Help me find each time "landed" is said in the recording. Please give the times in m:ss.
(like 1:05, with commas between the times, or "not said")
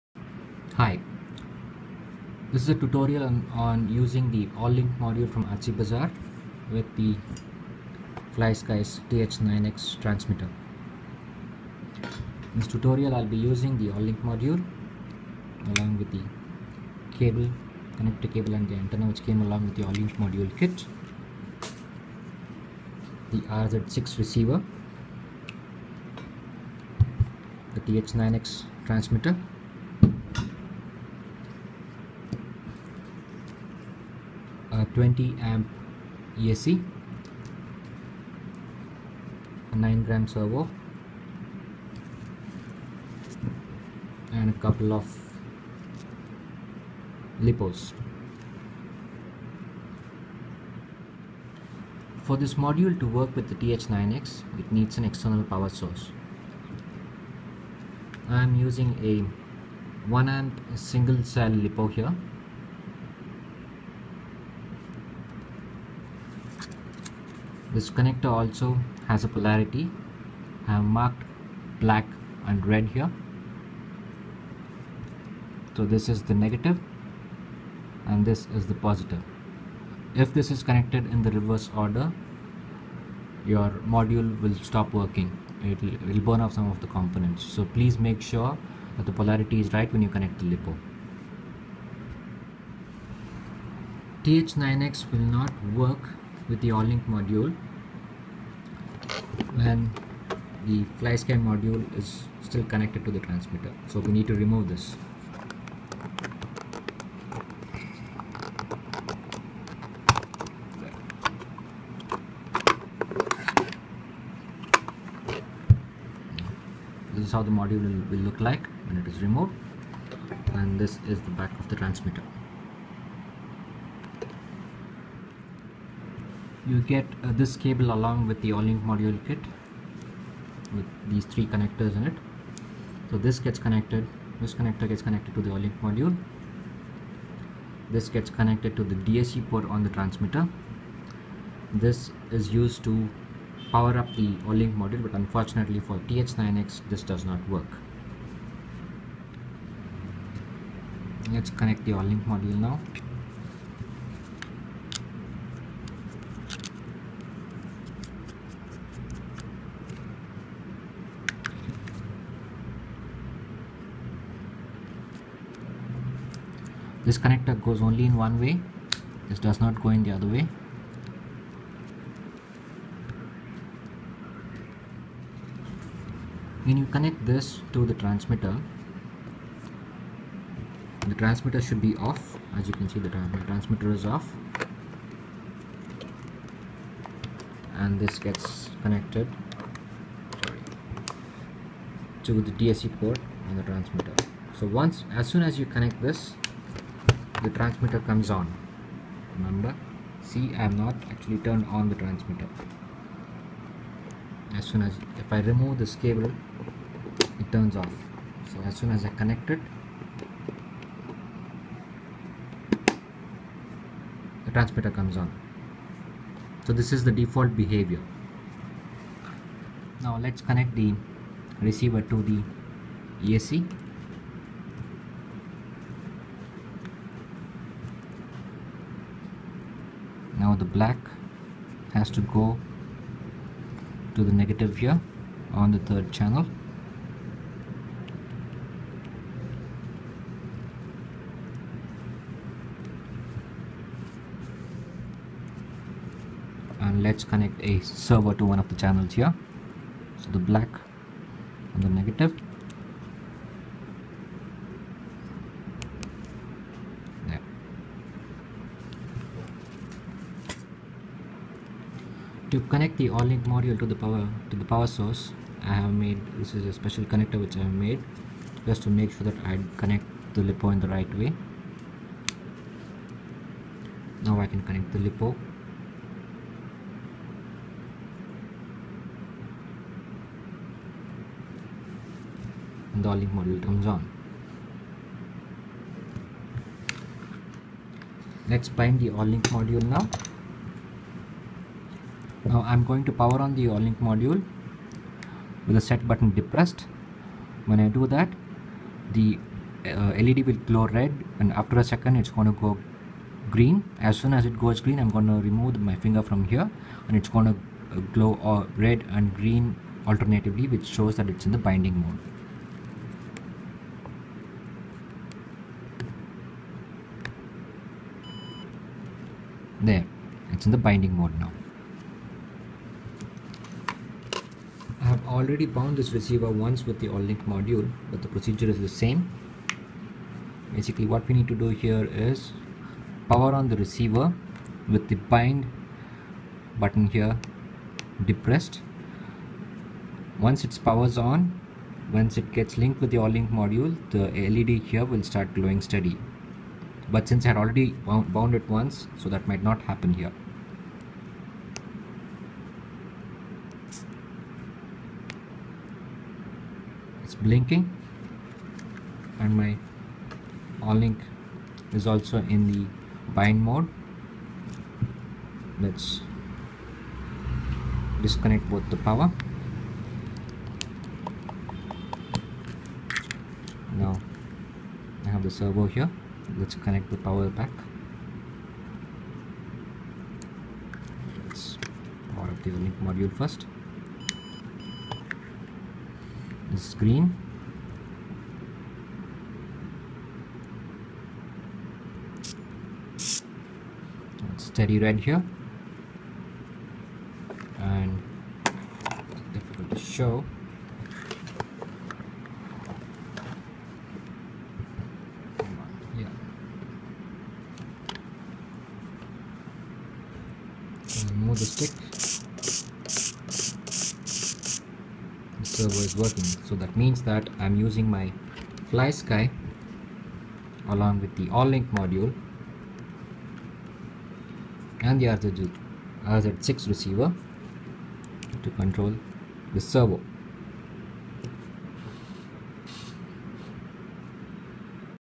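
not said.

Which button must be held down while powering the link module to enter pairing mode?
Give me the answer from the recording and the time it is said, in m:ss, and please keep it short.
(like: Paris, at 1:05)
set button, at 4:55.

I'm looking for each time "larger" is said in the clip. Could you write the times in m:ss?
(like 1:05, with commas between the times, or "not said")
not said.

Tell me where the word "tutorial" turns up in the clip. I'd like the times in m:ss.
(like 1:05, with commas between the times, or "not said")
0:02, 0:12.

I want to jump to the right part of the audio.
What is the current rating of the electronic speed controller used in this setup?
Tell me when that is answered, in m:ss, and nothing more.
0:34.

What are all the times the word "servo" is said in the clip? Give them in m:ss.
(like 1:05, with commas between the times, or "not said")
0:40, 4:08, 6:15, 6:55, 7:09.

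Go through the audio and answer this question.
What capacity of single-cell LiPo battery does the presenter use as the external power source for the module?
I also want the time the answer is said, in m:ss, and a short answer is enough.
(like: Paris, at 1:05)
1 amp, at 1:00.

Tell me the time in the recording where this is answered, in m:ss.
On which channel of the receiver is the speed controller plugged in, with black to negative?
3:55.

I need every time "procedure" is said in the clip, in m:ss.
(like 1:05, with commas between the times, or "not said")
5:28.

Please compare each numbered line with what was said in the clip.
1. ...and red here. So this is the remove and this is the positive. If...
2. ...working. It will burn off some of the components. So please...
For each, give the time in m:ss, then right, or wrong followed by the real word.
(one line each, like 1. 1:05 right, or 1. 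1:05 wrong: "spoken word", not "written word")
1. 1:12 wrong: "negative", not "remove"
2. 1:24 right.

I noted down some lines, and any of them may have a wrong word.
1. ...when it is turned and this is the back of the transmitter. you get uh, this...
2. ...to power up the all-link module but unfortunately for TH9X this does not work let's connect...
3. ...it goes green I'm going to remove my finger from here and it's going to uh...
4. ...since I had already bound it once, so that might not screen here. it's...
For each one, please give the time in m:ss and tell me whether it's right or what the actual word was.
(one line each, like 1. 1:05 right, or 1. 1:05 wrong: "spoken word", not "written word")
1. 1:58 wrong: "removed", not "turned"
2. 2:22 right
3. 5:04 right
4. 5:47 wrong: "happen", not "screen".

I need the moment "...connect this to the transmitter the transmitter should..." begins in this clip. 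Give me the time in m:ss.
2:56.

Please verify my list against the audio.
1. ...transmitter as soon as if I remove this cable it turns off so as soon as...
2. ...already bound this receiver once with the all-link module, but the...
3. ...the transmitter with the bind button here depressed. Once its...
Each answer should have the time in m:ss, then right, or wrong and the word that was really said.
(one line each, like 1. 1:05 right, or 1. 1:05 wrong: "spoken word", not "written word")
1. 3:21 right
2. 5:25 right
3. 5:33 wrong: "receiver", not "transmitter".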